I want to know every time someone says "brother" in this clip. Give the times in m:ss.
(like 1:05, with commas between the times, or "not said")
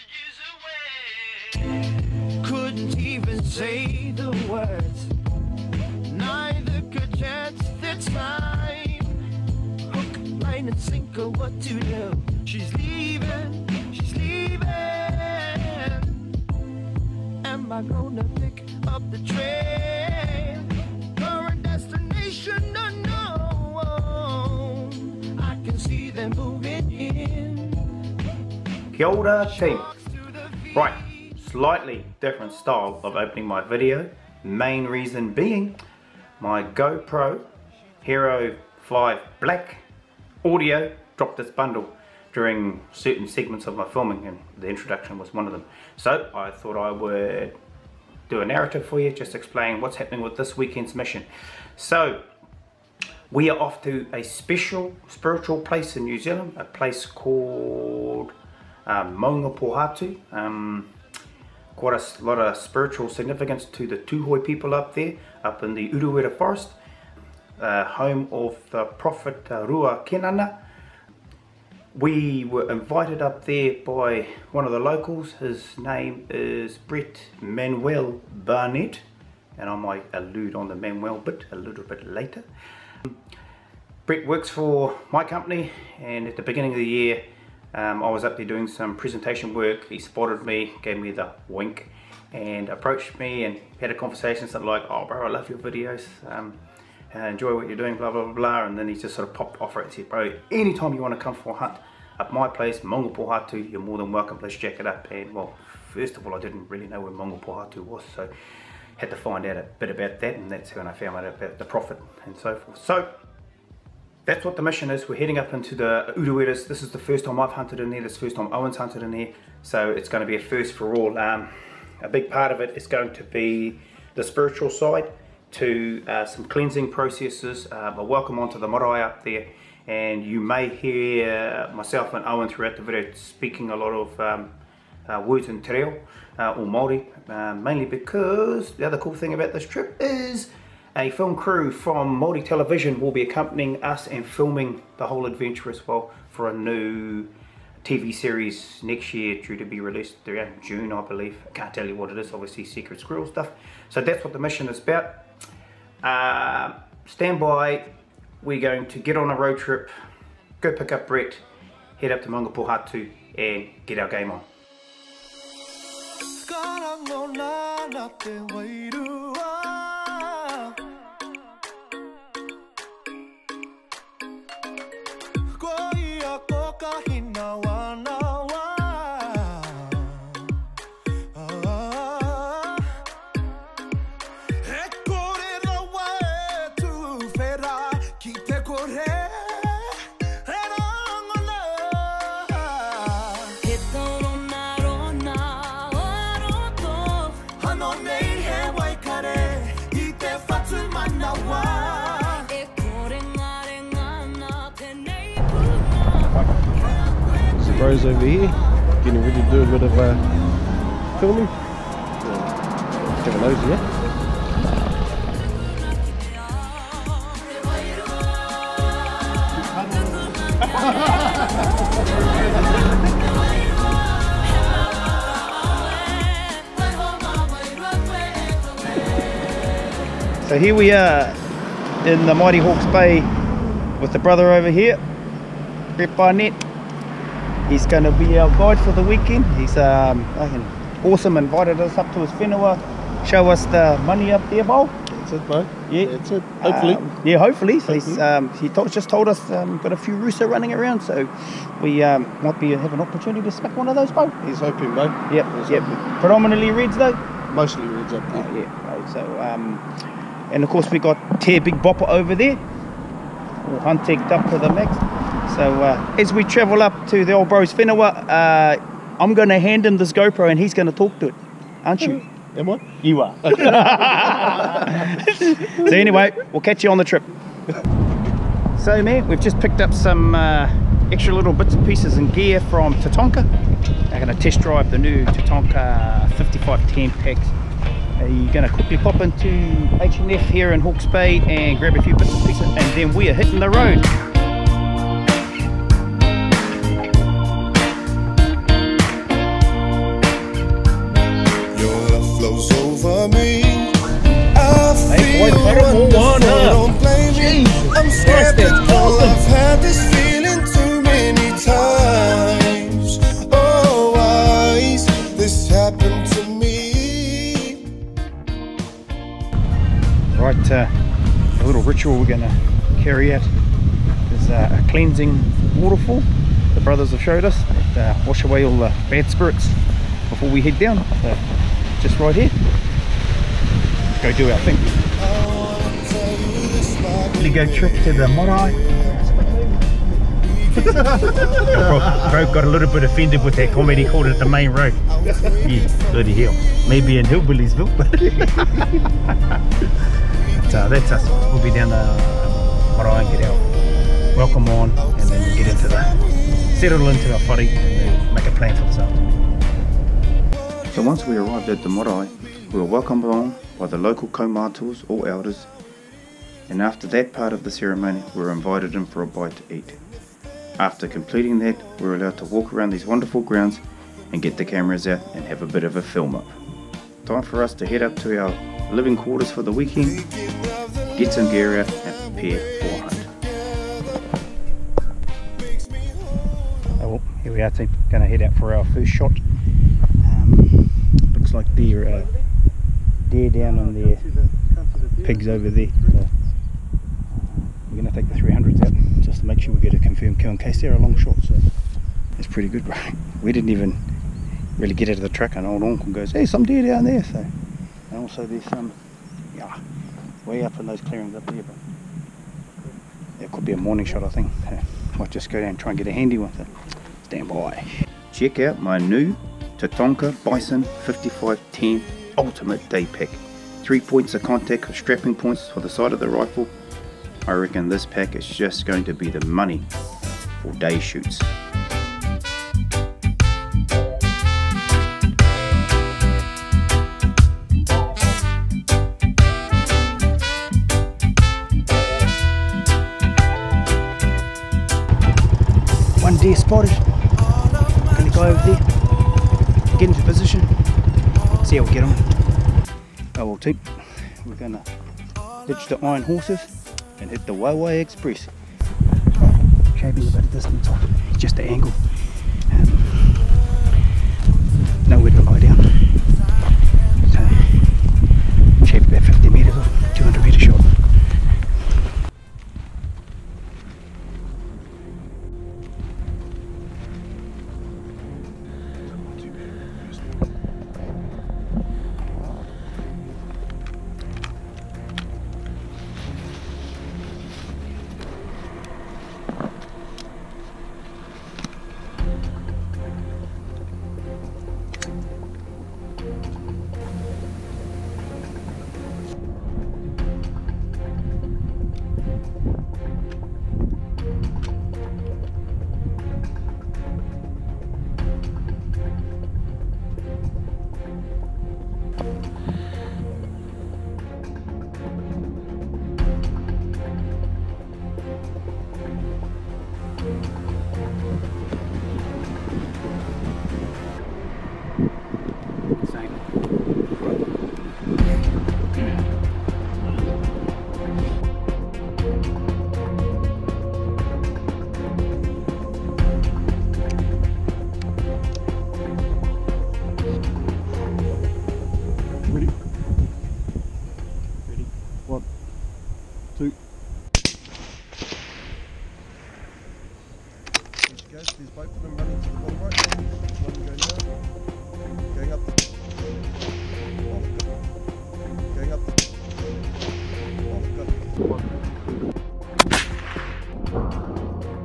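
3:54, 5:26.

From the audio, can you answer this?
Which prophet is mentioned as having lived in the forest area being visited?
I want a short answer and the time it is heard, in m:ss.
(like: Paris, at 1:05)
Rua Kenana, at 1:09.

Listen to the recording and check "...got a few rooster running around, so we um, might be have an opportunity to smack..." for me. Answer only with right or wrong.
right.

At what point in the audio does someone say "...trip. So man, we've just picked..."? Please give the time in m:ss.
4:37.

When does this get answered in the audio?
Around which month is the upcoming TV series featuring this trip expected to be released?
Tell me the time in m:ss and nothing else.
2:30.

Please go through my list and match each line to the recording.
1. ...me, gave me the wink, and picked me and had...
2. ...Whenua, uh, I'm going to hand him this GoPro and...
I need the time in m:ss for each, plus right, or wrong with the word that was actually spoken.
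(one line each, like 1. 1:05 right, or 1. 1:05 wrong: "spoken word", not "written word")
1. 1:30 wrong: "approached", not "picked"
2. 4:27 right.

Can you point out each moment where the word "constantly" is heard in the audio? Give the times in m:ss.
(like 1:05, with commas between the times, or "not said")
not said.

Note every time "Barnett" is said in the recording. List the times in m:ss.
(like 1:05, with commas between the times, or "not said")
1:18, 3:56.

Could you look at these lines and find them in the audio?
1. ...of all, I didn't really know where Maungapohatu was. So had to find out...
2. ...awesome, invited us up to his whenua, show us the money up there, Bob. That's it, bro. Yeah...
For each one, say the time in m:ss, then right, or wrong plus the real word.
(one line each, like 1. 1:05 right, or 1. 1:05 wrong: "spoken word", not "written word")
1. 1:46 right
2. 4:01 right.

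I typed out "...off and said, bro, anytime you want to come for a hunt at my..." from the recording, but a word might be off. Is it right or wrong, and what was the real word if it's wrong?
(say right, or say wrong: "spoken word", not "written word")
right.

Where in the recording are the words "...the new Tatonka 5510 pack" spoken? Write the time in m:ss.
4:44.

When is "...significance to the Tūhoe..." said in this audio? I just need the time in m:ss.
1:03.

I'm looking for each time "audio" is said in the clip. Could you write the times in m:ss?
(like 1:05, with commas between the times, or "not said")
0:40.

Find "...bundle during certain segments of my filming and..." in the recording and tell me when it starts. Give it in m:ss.
0:41.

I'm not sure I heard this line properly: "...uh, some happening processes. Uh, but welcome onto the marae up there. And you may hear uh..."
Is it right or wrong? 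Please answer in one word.
wrong.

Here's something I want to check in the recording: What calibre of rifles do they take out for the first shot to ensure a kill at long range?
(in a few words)
300s.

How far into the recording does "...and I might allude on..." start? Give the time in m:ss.
1:19.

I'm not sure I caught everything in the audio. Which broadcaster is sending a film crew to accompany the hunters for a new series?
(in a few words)
Māori Television.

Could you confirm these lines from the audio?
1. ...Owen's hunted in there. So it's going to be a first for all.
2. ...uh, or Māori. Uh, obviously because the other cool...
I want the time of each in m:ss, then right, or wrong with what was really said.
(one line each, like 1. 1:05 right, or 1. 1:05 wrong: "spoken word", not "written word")
1. 1:58 right
2. 2:16 wrong: "mainly", not "obviously".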